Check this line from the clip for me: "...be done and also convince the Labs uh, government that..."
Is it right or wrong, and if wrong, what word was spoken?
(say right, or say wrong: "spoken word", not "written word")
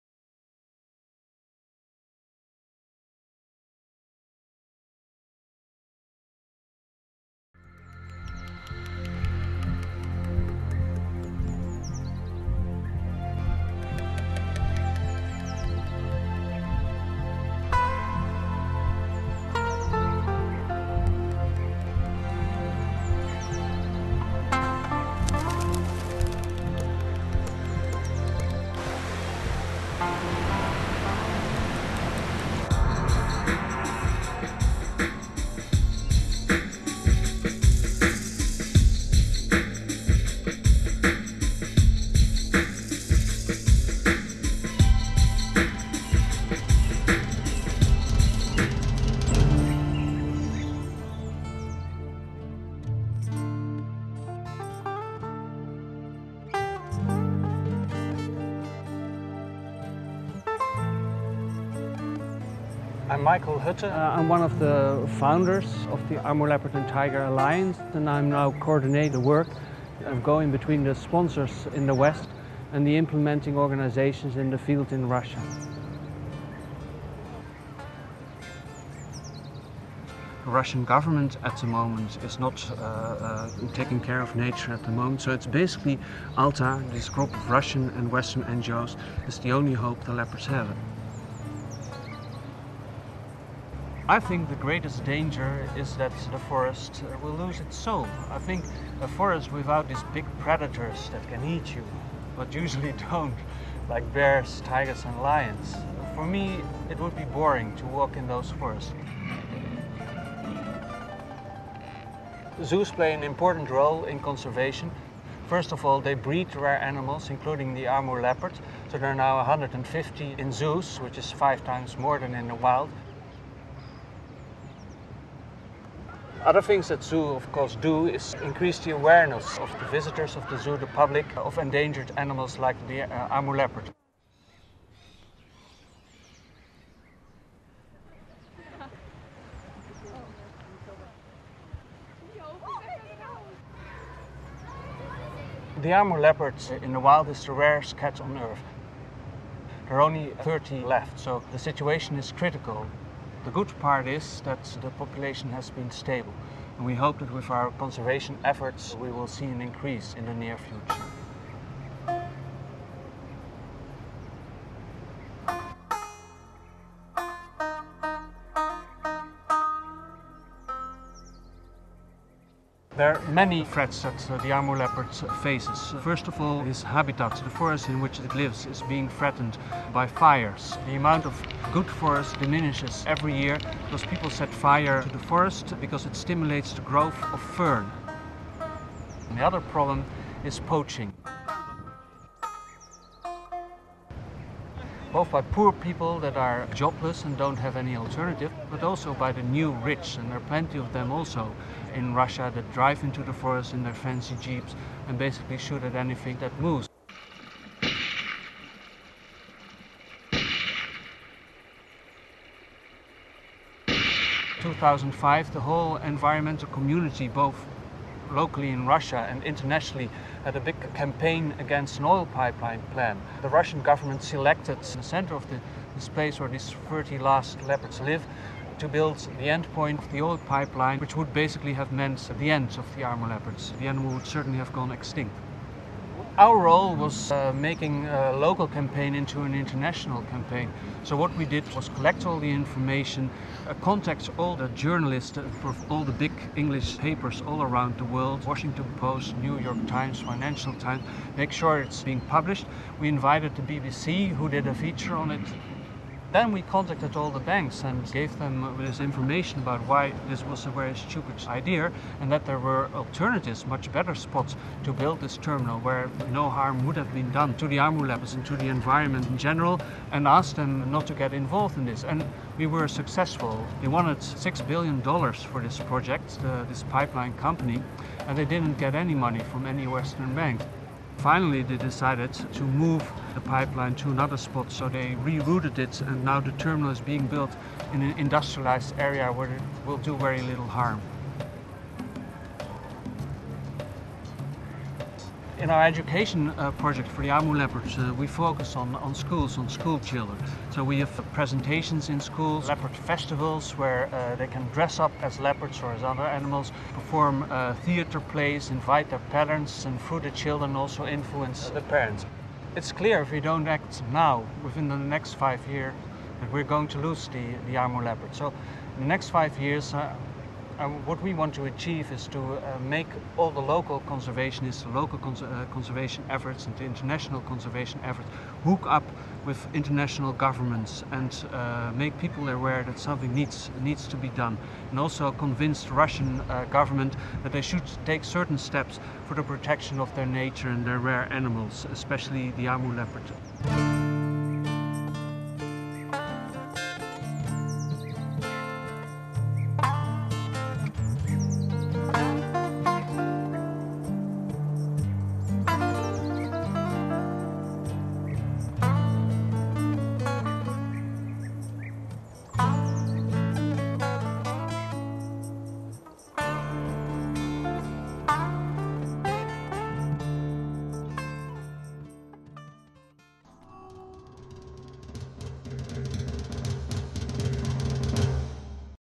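wrong: "Russian", not "Labs".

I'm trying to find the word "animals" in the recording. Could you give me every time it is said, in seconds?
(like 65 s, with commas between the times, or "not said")
116 s, 132 s, 233 s, 306 s, 341 s.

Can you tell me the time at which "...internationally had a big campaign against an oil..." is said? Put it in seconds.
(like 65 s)
219 s.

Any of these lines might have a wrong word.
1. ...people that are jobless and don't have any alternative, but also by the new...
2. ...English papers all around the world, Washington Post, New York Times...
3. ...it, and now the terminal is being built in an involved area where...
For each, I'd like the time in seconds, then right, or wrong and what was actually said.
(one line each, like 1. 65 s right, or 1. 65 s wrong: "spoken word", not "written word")
1. 195 s right
2. 246 s right
3. 285 s wrong: "industrialized", not "involved".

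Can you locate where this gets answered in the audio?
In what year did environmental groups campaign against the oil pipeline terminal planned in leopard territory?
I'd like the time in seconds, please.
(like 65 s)
214 s.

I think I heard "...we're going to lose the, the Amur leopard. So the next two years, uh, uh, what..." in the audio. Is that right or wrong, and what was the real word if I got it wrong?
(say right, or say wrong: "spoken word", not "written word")
wrong: "five", not "two".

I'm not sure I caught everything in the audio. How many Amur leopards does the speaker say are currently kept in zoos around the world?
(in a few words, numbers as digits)
150.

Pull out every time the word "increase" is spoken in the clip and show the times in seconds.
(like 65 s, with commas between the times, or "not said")
128 s, 159 s.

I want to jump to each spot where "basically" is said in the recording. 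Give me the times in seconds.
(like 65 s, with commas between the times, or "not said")
85 s, 205 s, 231 s.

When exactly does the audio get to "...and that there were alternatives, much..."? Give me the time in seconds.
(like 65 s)
262 s.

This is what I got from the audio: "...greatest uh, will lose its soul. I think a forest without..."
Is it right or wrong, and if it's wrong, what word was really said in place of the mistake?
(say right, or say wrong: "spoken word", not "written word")
wrong: "forest", not "greatest".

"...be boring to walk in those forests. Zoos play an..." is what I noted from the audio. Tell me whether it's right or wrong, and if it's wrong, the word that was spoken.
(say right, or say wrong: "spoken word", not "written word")
right.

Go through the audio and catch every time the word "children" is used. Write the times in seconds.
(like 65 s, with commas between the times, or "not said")
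299 s, 310 s.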